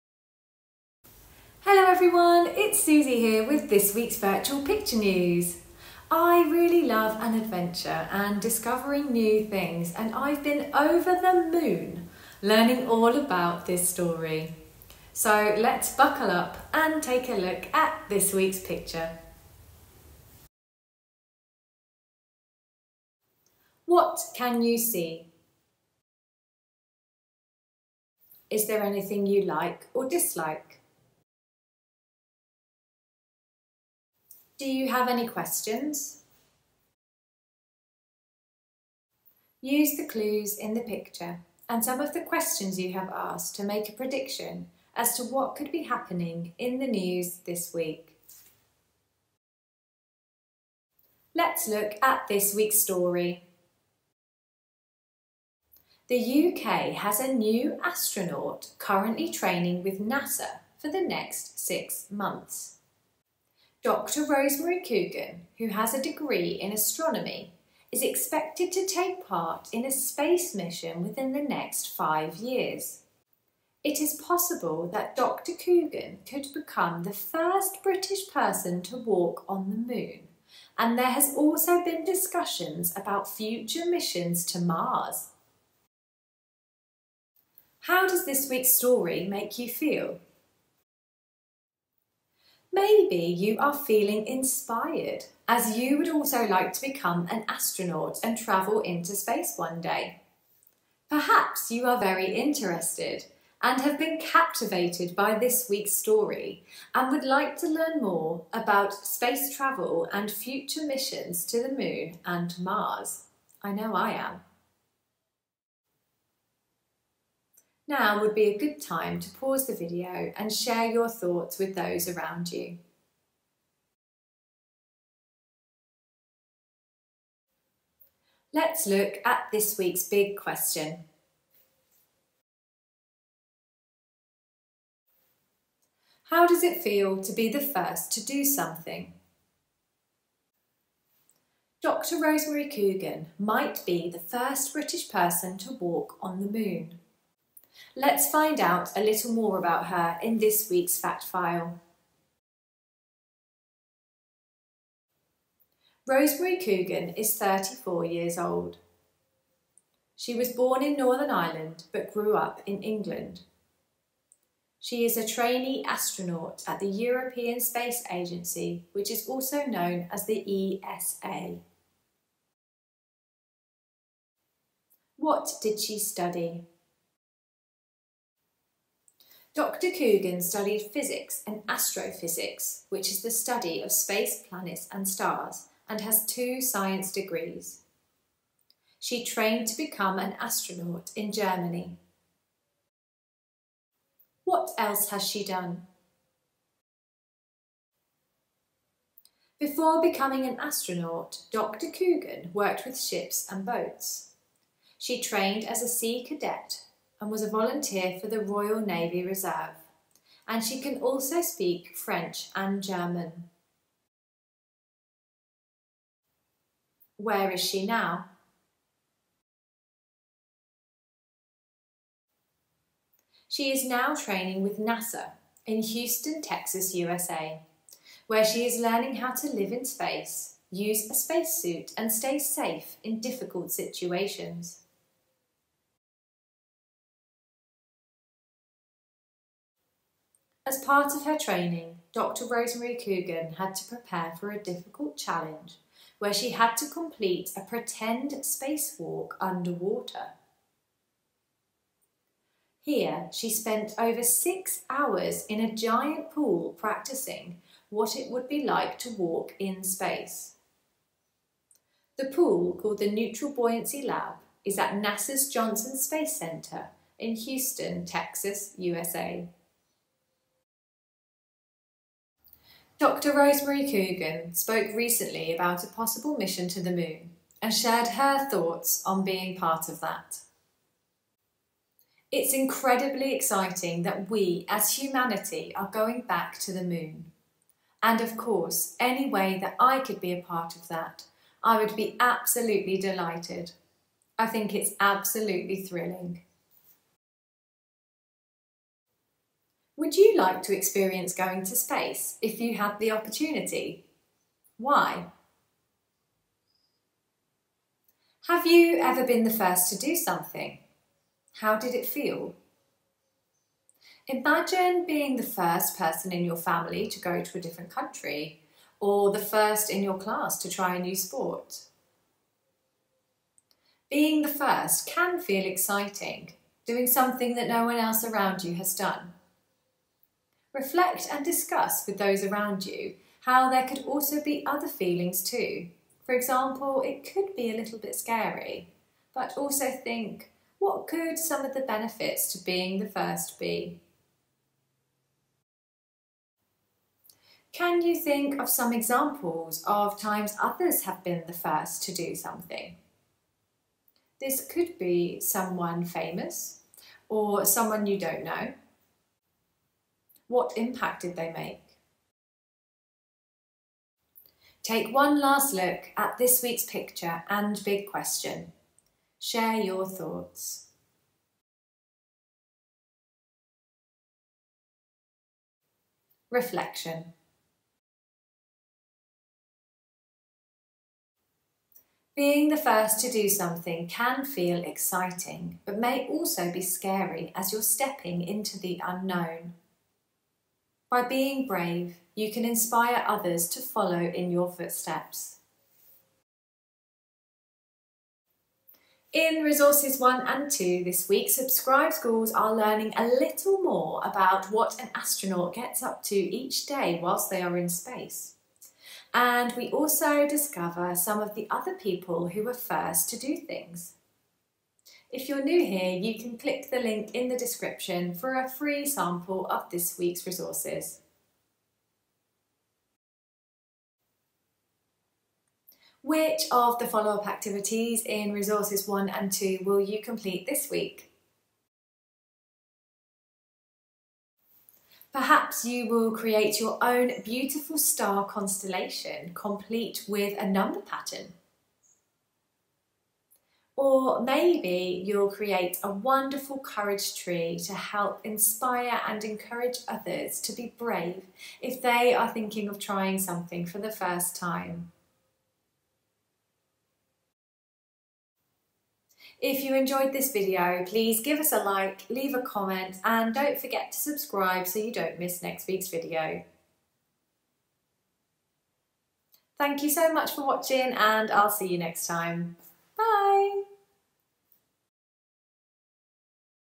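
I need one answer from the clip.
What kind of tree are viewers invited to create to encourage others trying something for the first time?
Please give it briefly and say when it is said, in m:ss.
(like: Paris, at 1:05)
courage tree, at 7:26.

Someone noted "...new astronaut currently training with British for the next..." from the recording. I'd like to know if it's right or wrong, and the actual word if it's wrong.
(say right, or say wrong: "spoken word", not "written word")
wrong: "NASA", not "British".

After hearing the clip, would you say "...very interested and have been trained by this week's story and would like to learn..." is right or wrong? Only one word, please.
wrong.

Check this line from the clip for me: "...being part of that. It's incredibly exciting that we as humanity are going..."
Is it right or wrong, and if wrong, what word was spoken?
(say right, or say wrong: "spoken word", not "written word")
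right.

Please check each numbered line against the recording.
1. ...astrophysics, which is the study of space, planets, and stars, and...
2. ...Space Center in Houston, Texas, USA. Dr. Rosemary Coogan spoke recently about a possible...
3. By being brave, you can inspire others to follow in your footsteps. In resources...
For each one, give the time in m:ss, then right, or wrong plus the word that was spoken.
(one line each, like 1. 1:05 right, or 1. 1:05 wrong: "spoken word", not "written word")
1. 3:01 right
2. 4:25 right
3. 6:31 right.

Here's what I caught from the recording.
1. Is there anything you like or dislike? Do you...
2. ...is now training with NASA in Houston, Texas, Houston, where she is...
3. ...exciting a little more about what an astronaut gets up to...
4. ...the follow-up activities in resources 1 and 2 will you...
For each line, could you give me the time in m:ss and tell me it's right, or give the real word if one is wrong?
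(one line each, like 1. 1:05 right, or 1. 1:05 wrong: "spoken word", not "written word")
1. 0:28 right
2. 3:43 wrong: "USA", not "Houston"
3. 6:42 wrong: "learning", not "exciting"
4. 7:06 right.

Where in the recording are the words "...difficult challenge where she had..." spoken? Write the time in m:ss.
4:04.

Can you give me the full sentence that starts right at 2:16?
How does it feel to be the first to do something?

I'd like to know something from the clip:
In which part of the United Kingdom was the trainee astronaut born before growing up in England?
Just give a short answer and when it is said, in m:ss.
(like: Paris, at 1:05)
Northern Ireland, at 2:40.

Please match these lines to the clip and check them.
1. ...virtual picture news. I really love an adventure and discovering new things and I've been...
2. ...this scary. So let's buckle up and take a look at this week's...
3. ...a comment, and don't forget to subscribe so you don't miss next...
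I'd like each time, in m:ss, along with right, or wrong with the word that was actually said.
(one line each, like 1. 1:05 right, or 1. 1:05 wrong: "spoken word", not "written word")
1. 0:04 right
2. 0:13 wrong: "story", not "scary"
3. 7:42 right.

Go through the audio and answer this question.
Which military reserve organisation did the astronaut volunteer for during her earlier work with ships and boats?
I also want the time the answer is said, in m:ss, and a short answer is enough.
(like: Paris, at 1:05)
Royal Navy Reserve, at 3:28.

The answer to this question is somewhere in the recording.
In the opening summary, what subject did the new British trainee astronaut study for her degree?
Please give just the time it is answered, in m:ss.
1:06.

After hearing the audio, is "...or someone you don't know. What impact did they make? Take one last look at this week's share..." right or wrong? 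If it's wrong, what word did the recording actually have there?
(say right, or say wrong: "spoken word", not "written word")
wrong: "picture", not "share".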